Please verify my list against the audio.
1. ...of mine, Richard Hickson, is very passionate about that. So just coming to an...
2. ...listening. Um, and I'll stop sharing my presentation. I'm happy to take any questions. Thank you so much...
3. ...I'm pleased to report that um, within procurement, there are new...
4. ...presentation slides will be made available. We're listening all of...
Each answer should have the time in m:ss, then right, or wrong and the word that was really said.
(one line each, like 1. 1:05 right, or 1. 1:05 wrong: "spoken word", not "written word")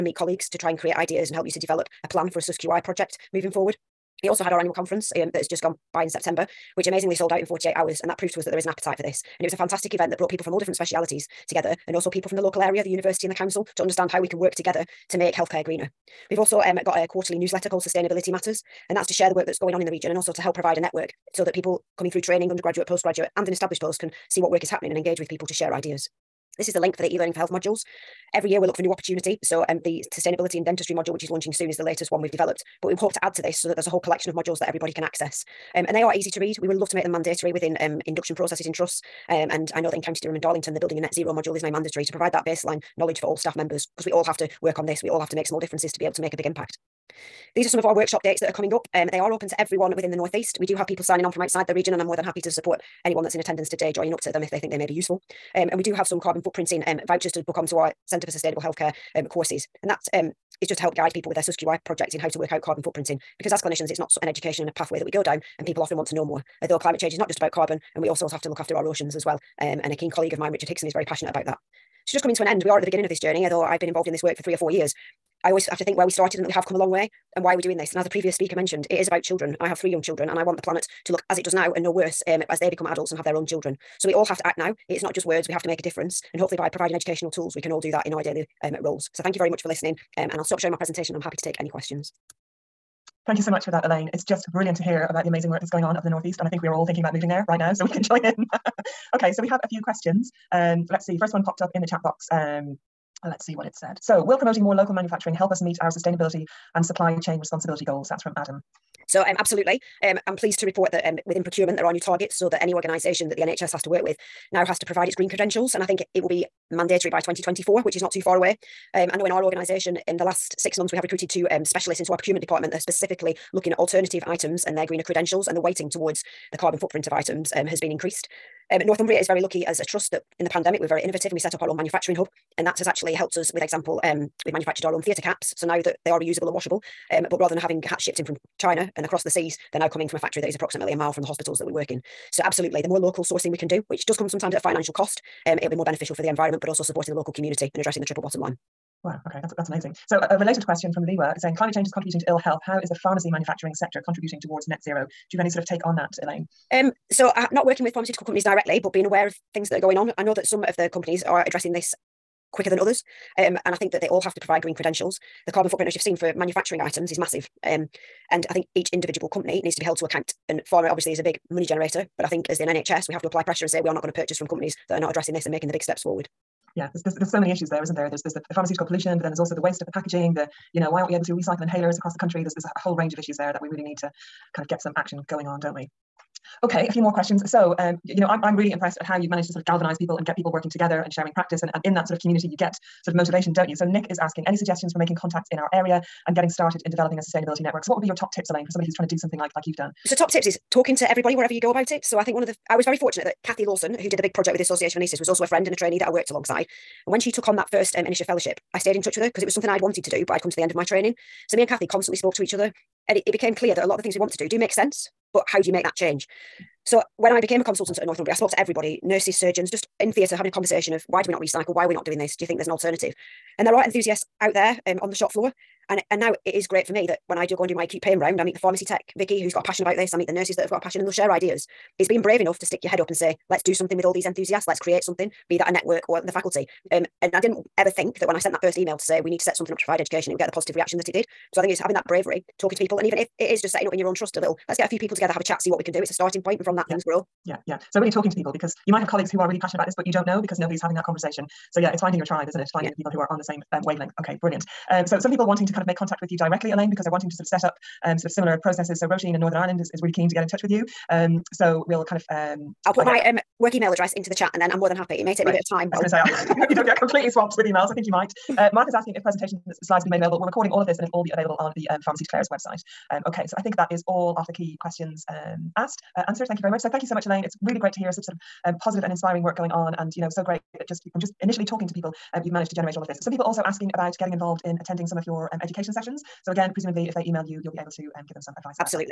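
1. 1:10 right
2. 1:29 right
3. 1:50 right
4. 4:29 wrong: "recording", not "listening".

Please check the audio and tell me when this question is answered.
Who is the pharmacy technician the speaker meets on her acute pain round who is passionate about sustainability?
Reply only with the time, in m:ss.
3:49.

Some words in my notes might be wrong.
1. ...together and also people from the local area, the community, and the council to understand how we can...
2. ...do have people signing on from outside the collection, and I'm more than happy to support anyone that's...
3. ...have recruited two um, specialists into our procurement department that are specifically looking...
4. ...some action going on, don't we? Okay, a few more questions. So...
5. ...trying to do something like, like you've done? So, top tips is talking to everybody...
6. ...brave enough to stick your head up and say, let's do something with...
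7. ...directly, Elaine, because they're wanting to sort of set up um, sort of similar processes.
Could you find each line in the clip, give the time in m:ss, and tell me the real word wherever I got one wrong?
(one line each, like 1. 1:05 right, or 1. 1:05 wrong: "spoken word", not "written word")
1. 0:11 wrong: "university", not "community"
2. 0:50 wrong: "region", not "collection"
3. 2:00 right
4. 3:04 right
5. 3:18 right
6. 3:52 right
7. 4:16 right.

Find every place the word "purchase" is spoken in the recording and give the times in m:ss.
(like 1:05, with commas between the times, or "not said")
2:54.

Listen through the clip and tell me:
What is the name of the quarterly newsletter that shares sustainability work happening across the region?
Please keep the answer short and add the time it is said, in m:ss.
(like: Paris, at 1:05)
Sustainability Matters, at 0:17.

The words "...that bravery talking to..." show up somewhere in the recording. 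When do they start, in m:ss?
4:01.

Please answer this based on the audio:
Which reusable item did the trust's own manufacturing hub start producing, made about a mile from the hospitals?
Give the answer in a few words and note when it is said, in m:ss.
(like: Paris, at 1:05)
Theatre caps, at 2:15.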